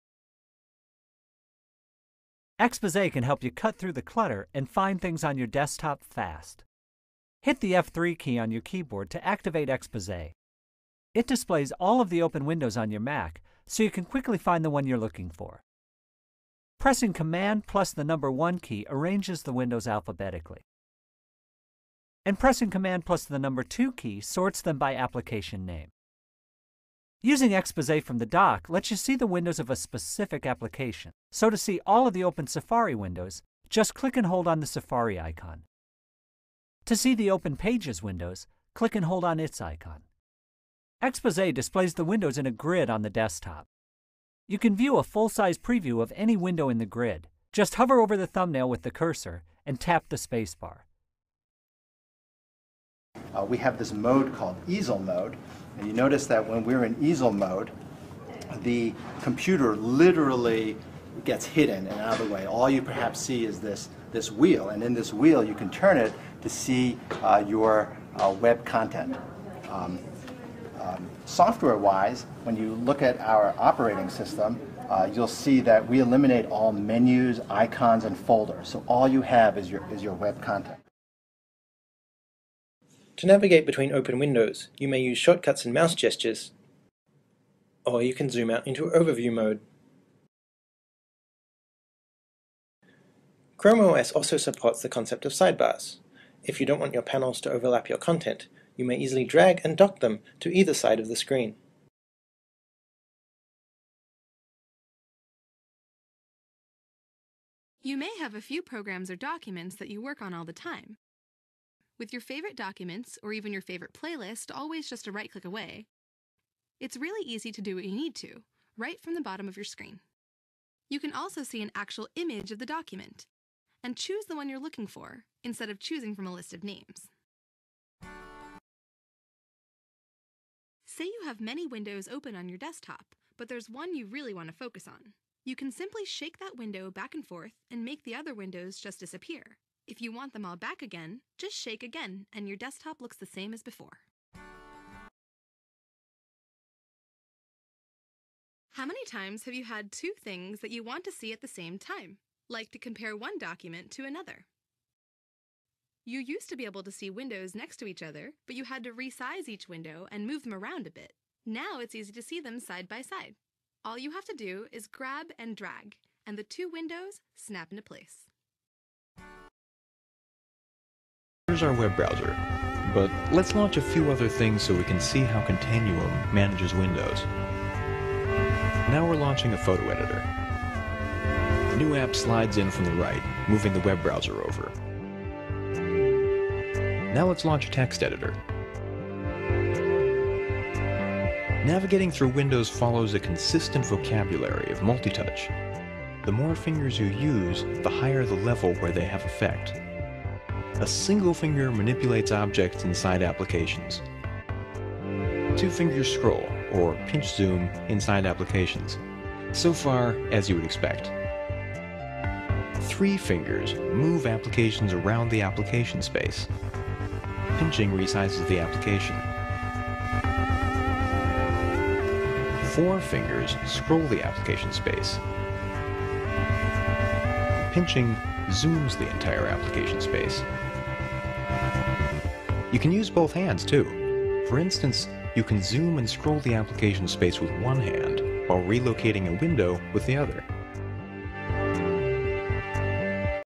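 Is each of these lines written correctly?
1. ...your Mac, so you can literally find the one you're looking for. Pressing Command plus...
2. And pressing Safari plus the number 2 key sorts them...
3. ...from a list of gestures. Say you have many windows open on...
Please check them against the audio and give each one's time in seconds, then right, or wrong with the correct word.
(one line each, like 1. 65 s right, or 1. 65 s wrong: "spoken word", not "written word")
1. 12 s wrong: "quickly", not "literally"
2. 22 s wrong: "Command", not "Safari"
3. 126 s wrong: "names", not "gestures".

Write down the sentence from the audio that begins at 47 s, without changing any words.
Just hover over the thumbnail with the cursor and tap the spacebar.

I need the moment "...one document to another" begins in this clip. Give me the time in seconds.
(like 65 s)
153 s.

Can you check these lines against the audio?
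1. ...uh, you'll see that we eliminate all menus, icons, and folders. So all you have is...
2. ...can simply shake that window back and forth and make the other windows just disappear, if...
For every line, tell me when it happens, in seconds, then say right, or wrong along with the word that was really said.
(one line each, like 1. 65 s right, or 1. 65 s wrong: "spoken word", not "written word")
1. 74 s right
2. 135 s right.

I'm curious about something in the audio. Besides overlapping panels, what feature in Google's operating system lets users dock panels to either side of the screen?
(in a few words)
sidebars.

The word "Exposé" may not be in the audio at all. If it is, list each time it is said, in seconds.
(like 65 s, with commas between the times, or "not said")
2 s, 9 s, 27 s, 41 s.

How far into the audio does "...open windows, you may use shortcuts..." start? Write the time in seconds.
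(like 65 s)
83 s.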